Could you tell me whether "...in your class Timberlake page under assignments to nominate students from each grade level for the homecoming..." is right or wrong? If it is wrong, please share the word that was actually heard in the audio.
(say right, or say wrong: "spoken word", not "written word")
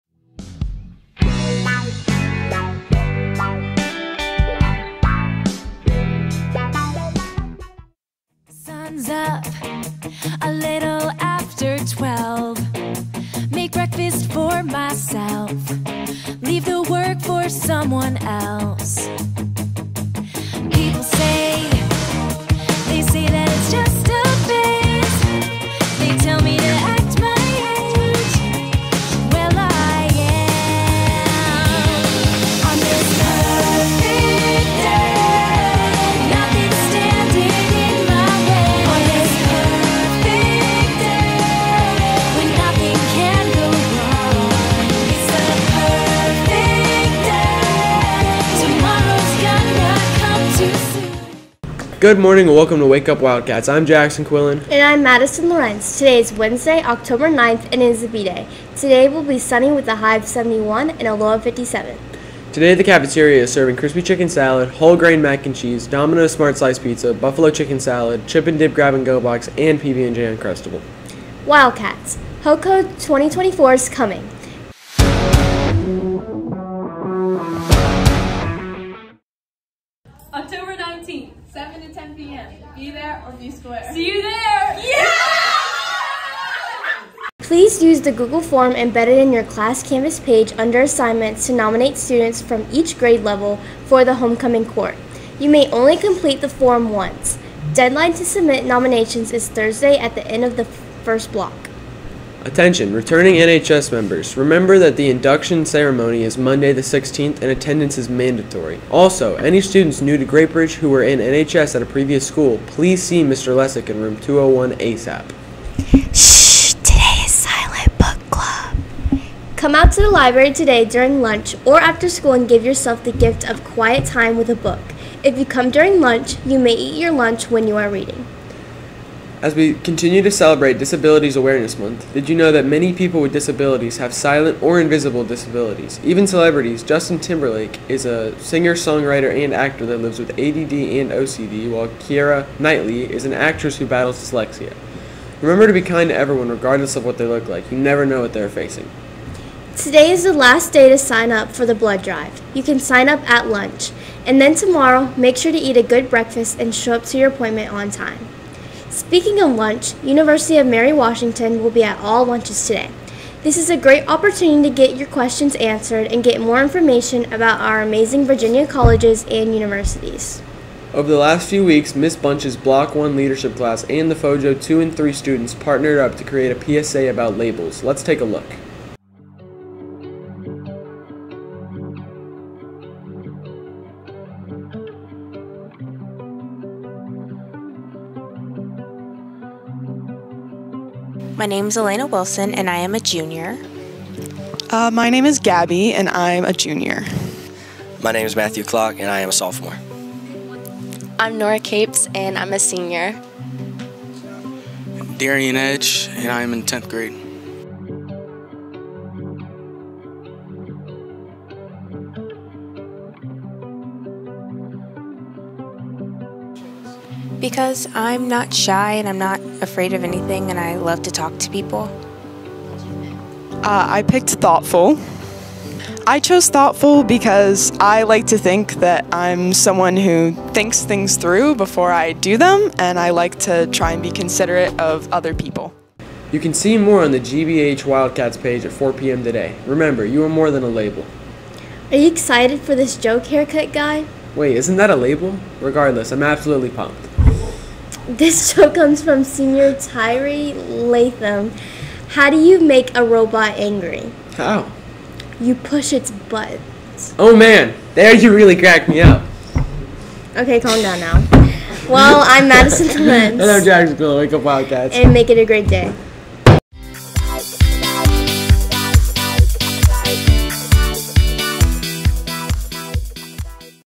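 wrong: "Canvas", not "Timberlake".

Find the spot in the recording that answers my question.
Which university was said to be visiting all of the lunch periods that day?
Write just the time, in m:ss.
2:40.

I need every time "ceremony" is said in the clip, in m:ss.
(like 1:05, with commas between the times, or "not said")
1:45.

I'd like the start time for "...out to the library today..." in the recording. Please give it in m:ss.
1:59.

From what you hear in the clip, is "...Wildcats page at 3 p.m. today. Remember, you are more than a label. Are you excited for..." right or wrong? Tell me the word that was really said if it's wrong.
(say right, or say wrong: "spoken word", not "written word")
wrong: "4", not "3".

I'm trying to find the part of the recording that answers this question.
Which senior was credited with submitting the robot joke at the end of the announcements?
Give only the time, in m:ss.
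4:09.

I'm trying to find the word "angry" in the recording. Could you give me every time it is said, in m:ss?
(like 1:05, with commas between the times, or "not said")
4:13.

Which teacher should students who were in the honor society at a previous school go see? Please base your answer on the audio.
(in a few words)
Mr. Lessick.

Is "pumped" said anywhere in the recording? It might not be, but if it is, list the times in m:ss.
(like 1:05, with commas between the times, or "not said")
4:06.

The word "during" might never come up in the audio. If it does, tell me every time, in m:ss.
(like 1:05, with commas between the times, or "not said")
2:00, 2:05.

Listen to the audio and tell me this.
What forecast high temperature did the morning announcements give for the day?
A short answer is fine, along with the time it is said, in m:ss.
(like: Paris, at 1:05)
71, at 1:00.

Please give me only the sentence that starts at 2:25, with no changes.
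Remember to be kind to everyone regardless of what they look like.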